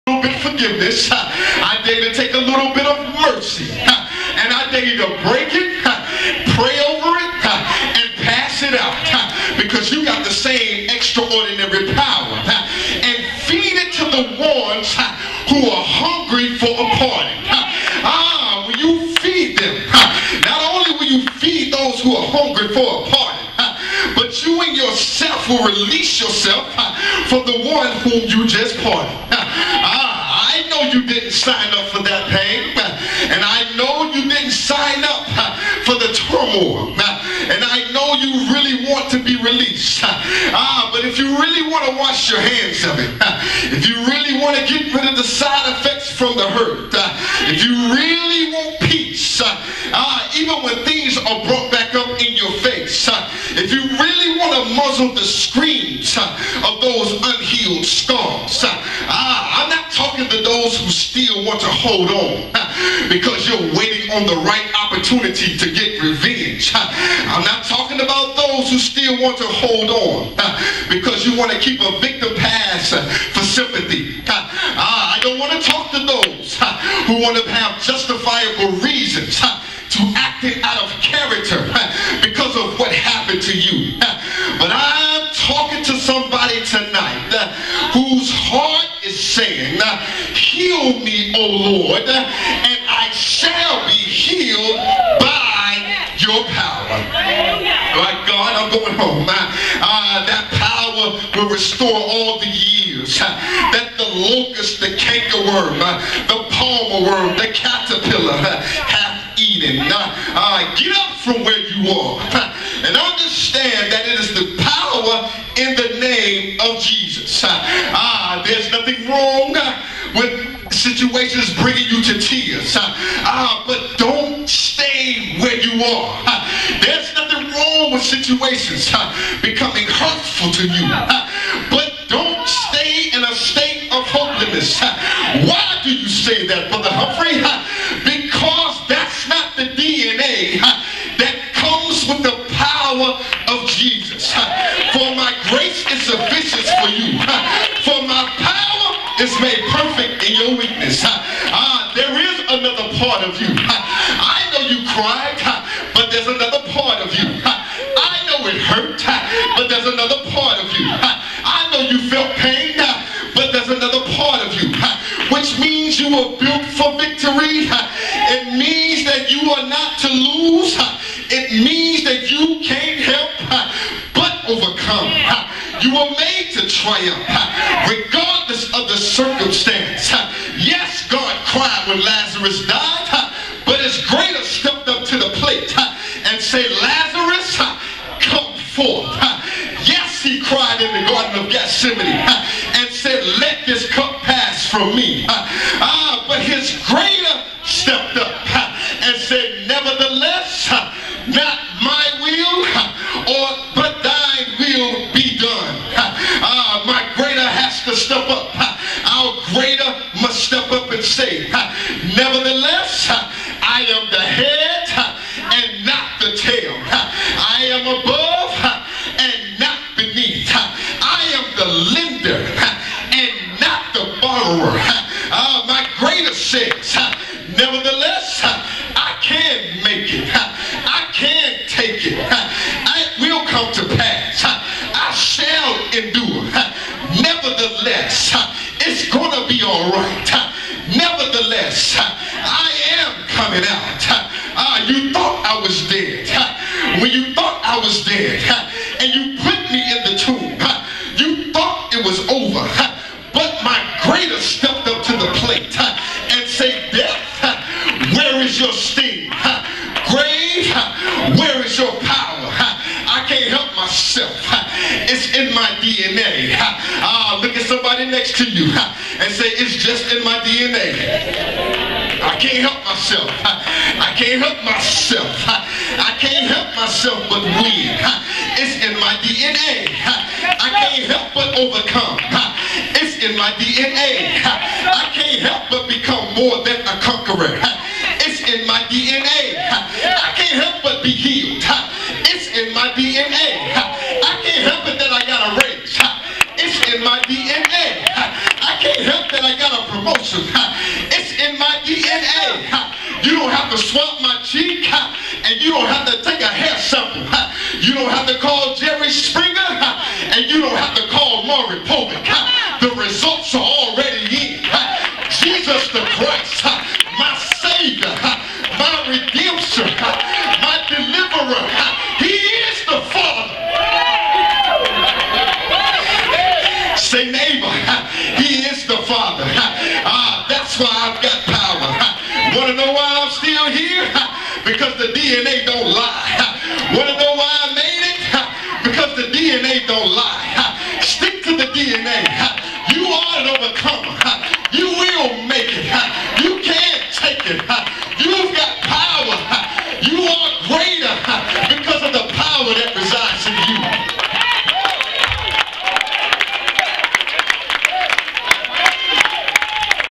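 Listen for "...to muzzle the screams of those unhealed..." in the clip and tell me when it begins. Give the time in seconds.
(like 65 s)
54 s.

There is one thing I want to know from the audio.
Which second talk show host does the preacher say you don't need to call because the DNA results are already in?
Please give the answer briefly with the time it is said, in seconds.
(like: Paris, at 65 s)
Maury Povich, at 311 s.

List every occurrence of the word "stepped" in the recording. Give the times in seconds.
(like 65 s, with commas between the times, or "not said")
184 s, 197 s.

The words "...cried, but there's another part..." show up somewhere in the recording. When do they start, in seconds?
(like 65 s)
154 s.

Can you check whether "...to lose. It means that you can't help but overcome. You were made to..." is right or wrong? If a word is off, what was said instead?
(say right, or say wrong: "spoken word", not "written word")
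right.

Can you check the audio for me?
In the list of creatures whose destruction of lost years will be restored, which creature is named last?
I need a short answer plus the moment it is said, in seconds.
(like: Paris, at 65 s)
caterpillar, at 107 s.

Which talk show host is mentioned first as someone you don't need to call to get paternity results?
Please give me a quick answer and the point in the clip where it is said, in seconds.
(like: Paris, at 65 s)
Jerry Springer, at 308 s.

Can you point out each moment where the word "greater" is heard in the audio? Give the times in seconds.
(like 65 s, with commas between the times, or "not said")
184 s, 196 s, 225 s.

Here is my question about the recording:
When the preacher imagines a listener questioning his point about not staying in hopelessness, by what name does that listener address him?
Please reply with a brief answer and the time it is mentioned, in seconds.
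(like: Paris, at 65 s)
Brother Humphrey, at 136 s.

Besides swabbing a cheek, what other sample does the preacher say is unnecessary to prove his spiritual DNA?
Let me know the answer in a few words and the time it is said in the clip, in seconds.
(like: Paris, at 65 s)
hair sample, at 306 s.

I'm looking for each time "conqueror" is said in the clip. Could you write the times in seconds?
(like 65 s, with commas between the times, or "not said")
287 s.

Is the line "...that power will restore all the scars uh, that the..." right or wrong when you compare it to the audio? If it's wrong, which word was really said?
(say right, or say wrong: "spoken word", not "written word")
wrong: "years", not "scars".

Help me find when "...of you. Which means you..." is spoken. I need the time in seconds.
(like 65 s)
164 s.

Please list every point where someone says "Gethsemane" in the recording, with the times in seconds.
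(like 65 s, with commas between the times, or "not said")
191 s.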